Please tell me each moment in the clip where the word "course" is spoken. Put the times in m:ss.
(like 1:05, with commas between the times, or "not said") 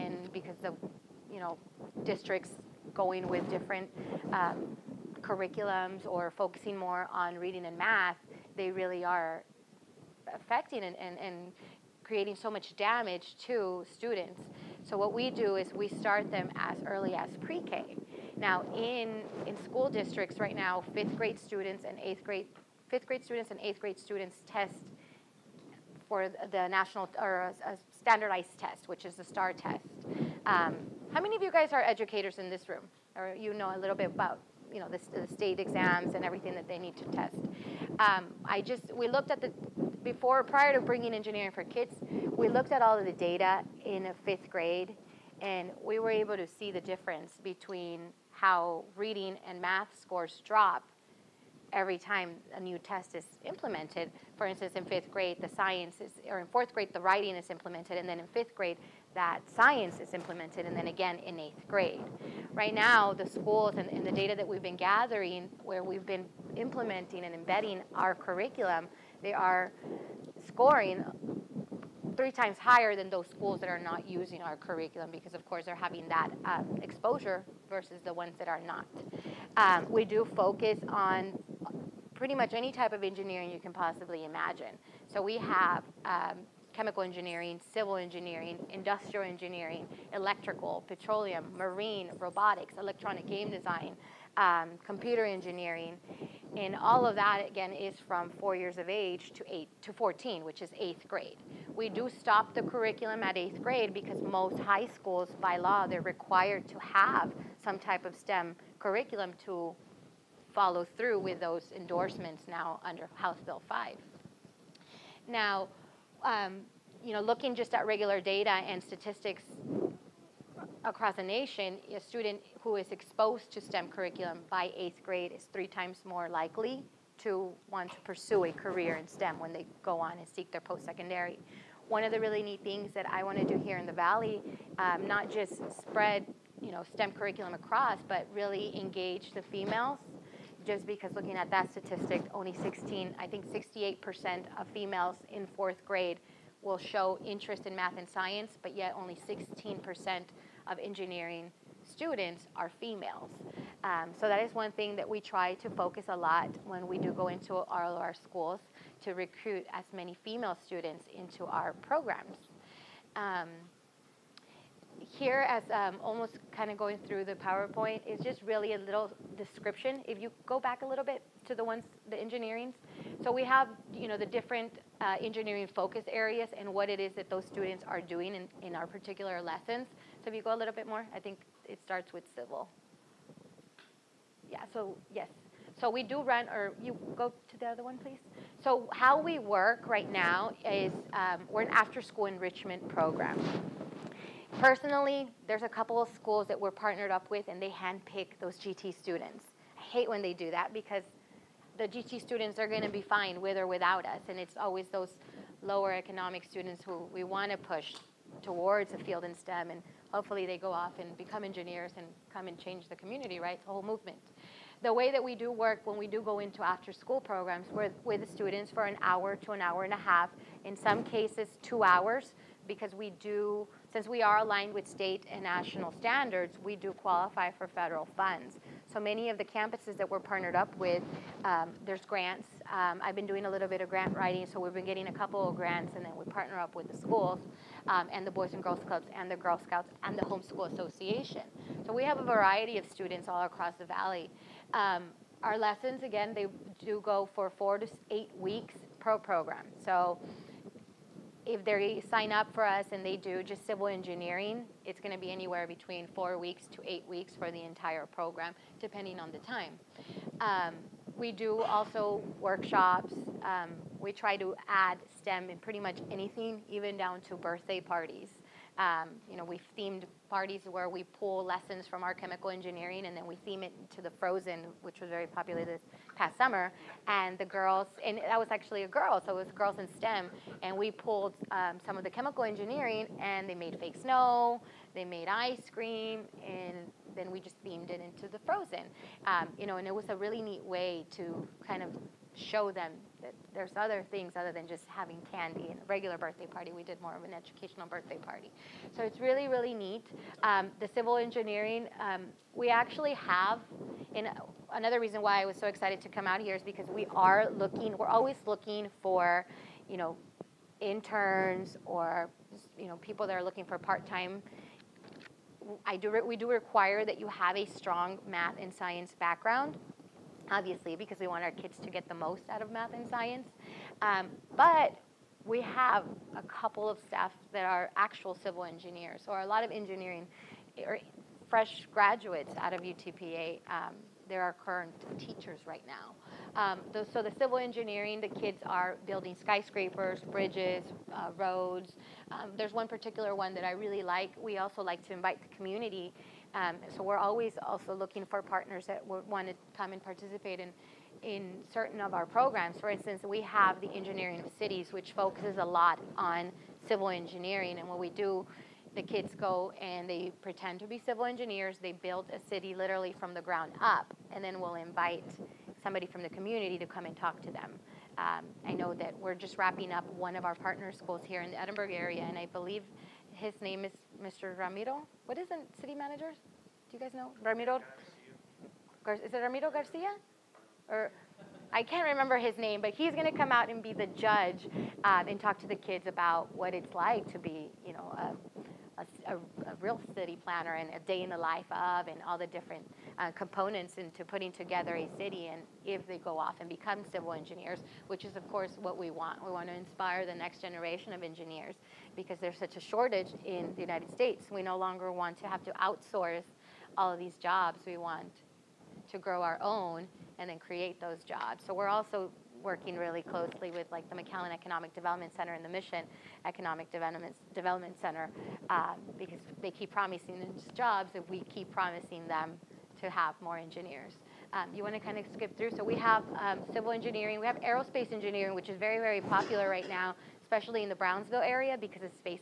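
1:15, 6:38.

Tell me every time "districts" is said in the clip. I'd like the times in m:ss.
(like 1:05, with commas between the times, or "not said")
0:02, 0:19.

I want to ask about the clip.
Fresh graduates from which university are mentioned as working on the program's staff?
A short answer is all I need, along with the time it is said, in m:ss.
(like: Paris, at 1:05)
UTPA, at 5:32.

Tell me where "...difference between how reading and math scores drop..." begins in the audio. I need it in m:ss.
0:46.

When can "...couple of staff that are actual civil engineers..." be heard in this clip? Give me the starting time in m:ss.
5:26.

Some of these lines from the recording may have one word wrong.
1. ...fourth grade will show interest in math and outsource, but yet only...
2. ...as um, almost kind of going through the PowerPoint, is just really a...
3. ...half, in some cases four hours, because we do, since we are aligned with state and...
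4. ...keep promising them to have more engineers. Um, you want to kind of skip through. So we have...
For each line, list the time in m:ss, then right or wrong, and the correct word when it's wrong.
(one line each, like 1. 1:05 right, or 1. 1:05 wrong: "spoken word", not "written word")
1. 2:25 wrong: "science", not "outsource"
2. 2:45 right
3. 3:40 wrong: "two", not "four"
4. 7:01 right.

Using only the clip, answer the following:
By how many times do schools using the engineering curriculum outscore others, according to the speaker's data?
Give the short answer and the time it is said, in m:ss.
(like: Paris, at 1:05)
3 times, at 1:12.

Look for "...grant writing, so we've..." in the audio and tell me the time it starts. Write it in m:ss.
3:53.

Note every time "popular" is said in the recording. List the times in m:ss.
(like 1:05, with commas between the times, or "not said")
4:35, 7:09.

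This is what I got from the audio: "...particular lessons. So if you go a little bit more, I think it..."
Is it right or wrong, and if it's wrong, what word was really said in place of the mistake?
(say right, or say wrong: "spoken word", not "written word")
right.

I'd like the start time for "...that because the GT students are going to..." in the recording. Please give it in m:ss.
3:20.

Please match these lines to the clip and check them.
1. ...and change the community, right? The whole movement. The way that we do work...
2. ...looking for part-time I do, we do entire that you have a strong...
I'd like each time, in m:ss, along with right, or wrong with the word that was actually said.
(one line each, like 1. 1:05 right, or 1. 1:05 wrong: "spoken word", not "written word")
1. 3:32 right
2. 5:13 wrong: "require", not "entire".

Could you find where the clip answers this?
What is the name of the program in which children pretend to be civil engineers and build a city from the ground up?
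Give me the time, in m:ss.
5:53.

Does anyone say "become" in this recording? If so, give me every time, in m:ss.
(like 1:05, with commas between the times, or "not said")
3:31, 6:36.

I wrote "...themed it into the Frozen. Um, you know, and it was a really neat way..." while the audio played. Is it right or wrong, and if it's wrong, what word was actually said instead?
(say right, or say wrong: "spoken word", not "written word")
right.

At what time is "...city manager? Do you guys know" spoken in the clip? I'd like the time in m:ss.
6:15.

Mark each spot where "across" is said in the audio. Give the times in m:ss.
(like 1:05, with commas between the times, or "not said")
2:00, 2:17, 4:03.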